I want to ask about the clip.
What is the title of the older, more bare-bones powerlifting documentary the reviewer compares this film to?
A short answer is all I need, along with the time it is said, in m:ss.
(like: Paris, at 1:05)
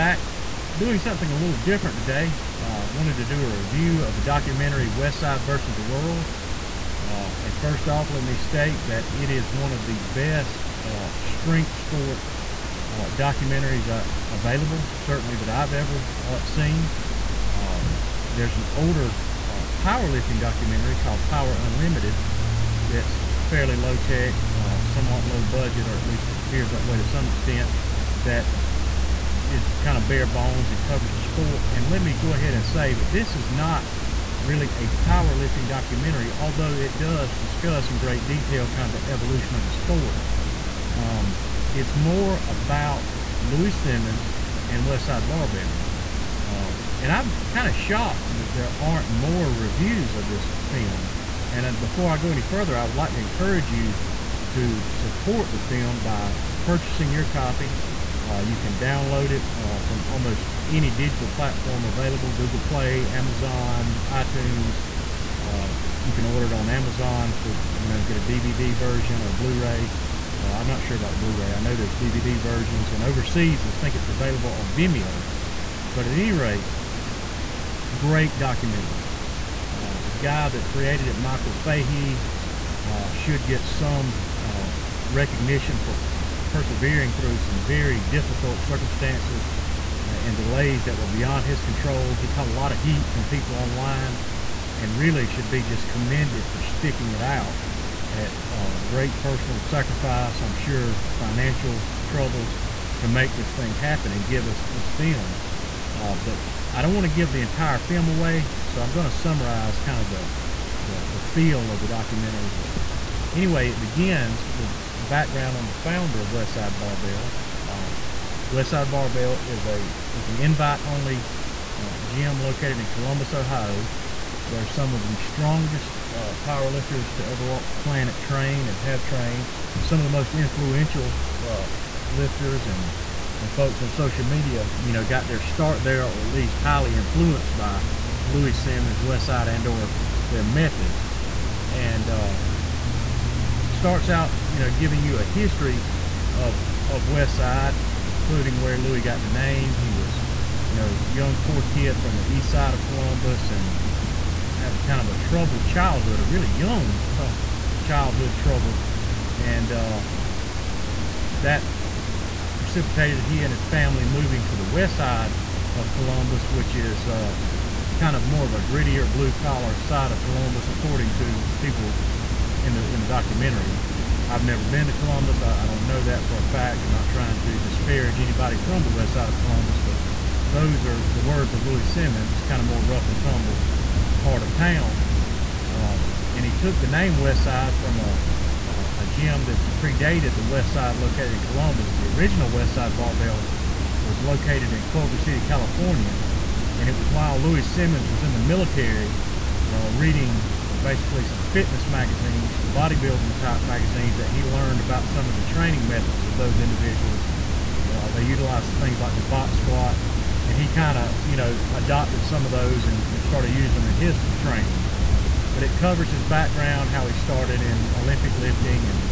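Power Unlimited, at 0:21.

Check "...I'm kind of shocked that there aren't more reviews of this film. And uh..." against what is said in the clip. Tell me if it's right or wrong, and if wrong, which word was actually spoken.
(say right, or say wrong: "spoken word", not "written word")
right.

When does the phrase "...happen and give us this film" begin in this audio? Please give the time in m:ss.
1:43.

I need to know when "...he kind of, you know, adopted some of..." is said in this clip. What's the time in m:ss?
3:30.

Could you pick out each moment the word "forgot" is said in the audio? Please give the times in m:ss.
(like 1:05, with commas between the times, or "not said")
not said.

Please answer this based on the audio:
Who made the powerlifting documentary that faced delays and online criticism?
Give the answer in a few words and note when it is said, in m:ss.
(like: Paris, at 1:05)
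Michael Fahey, at 1:21.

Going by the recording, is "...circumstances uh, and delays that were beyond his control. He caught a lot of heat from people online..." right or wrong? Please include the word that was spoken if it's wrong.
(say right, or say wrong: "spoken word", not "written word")
right.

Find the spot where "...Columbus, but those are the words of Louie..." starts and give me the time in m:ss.
2:59.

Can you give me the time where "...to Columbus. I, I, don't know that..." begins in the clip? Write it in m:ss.
2:54.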